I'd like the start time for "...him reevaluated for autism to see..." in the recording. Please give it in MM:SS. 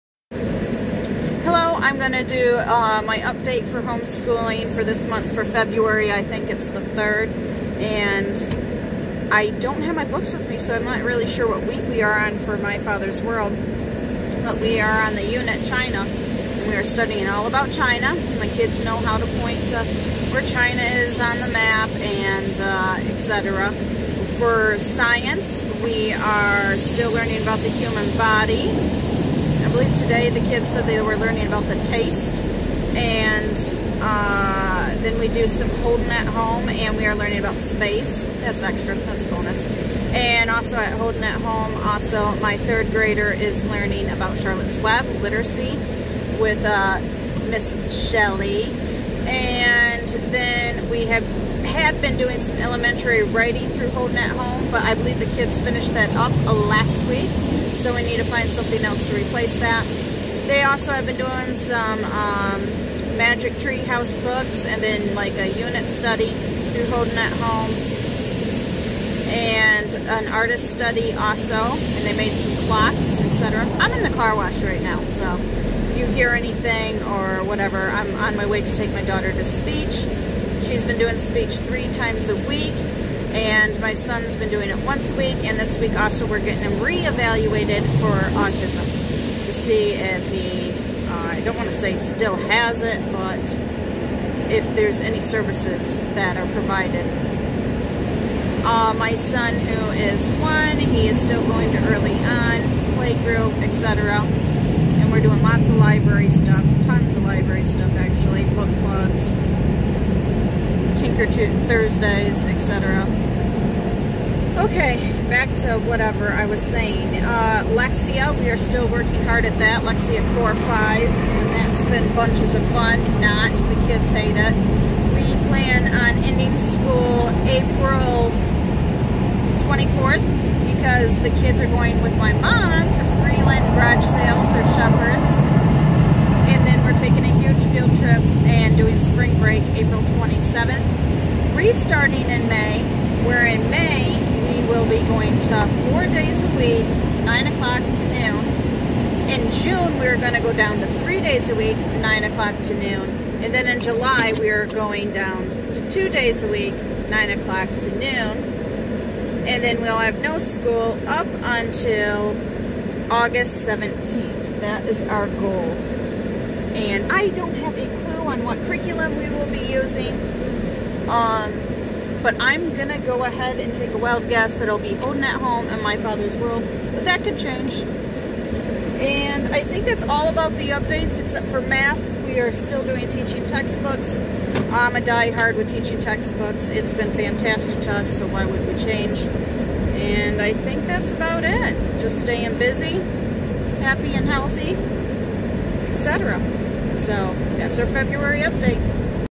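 01:26.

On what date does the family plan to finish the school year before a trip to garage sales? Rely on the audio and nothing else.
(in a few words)
April 24th.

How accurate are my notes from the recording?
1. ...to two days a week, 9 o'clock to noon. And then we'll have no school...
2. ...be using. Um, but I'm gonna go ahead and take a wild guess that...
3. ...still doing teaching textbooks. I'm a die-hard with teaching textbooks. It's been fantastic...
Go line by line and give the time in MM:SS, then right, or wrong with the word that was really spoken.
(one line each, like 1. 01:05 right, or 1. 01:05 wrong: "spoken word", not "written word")
1. 02:35 right
2. 02:49 right
3. 03:02 right.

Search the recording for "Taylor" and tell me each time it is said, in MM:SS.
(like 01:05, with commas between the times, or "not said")
not said.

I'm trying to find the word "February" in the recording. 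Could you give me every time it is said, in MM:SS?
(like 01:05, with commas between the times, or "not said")
00:05, 03:17.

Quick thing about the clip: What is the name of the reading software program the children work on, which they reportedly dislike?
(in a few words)
Lexia Core 5.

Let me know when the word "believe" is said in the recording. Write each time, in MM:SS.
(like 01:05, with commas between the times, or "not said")
00:29, 00:54.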